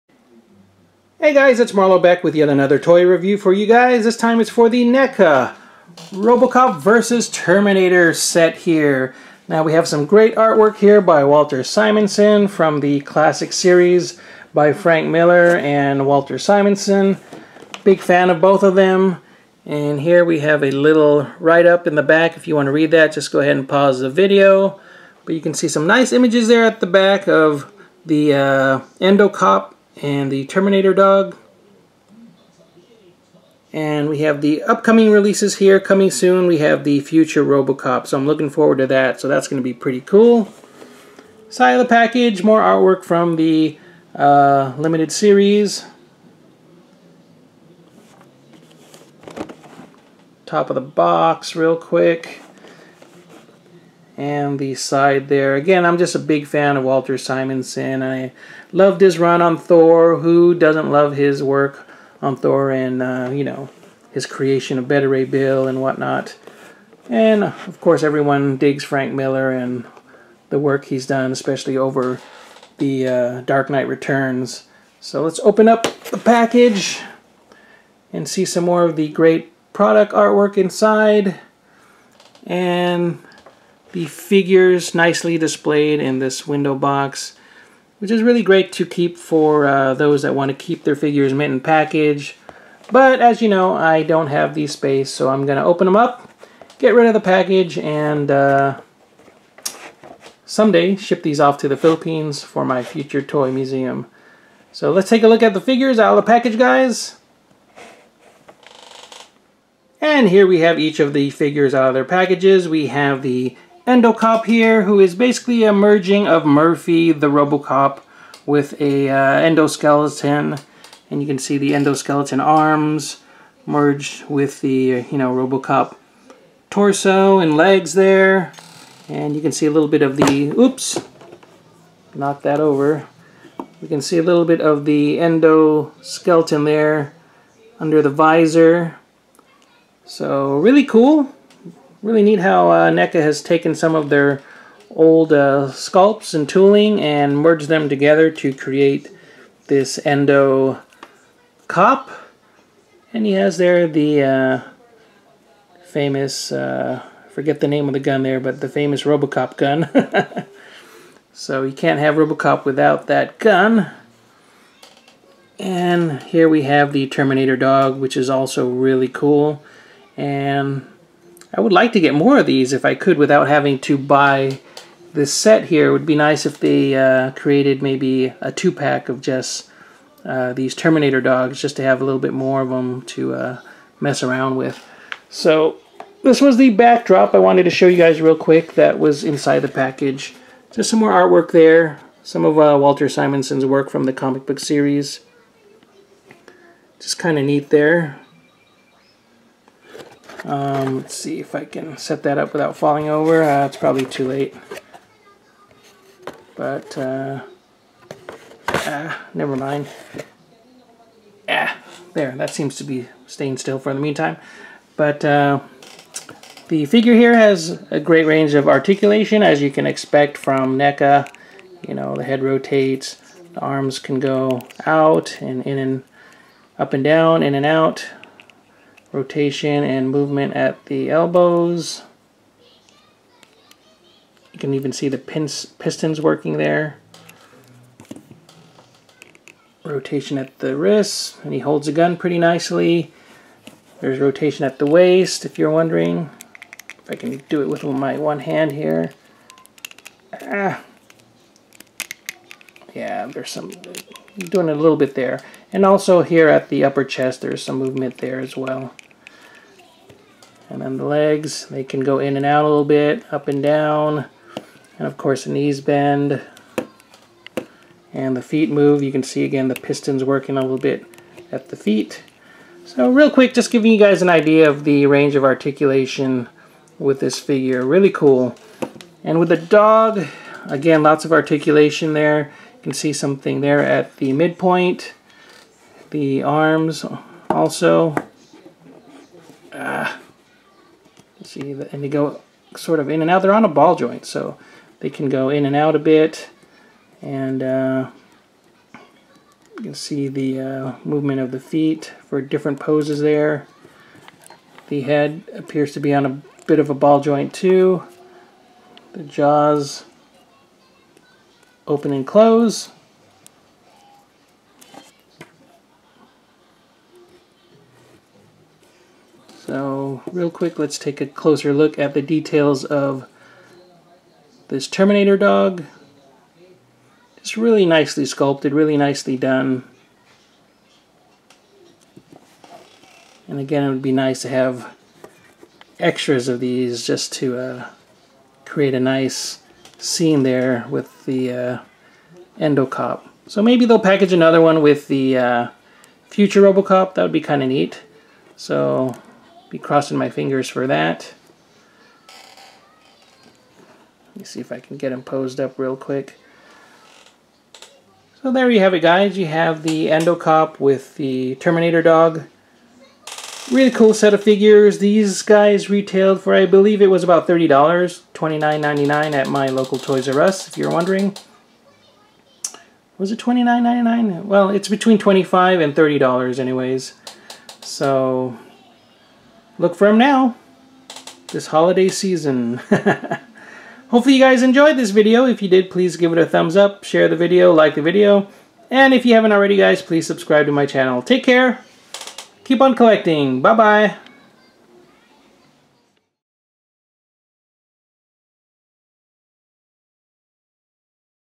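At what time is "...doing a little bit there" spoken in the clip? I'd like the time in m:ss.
4:14.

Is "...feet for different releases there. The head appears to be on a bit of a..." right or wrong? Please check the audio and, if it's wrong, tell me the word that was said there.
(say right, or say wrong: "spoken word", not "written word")
wrong: "poses", not "releases".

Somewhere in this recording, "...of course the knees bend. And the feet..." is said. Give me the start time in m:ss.
4:25.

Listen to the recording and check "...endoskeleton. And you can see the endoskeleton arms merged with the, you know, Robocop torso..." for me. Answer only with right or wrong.
right.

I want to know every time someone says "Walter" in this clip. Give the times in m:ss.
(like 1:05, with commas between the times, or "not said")
0:11, 0:16, 0:56, 3:12.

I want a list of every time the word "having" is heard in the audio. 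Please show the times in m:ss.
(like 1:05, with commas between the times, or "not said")
2:53.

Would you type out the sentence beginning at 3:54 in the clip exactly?
You can even see the pins, pistons working there.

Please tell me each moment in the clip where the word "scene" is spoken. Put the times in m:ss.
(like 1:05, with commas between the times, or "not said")
5:40.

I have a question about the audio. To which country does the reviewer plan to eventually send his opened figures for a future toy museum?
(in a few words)
the Philippines.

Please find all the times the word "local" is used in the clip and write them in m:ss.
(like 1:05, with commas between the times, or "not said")
6:09.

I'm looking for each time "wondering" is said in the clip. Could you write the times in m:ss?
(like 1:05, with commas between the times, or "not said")
4:05, 6:10.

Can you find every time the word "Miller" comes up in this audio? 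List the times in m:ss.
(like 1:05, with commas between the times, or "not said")
0:15, 1:09.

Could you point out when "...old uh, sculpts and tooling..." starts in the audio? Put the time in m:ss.
2:24.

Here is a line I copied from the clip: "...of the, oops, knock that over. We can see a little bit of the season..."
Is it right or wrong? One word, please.
wrong.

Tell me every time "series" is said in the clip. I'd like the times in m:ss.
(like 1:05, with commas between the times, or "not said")
0:13, 0:45, 3:14.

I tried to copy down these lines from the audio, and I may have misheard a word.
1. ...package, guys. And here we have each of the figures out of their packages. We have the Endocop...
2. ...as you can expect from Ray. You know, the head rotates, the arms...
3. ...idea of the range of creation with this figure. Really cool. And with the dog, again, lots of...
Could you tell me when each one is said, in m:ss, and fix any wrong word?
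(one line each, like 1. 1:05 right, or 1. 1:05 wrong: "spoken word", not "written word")
1. 1:46 right
2. 3:39 wrong: "NECA", not "Ray"
3. 4:34 wrong: "articulation", not "creation".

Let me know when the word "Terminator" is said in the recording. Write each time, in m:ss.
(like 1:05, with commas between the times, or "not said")
0:07, 0:30, 2:47, 3:00, 5:24, 6:01.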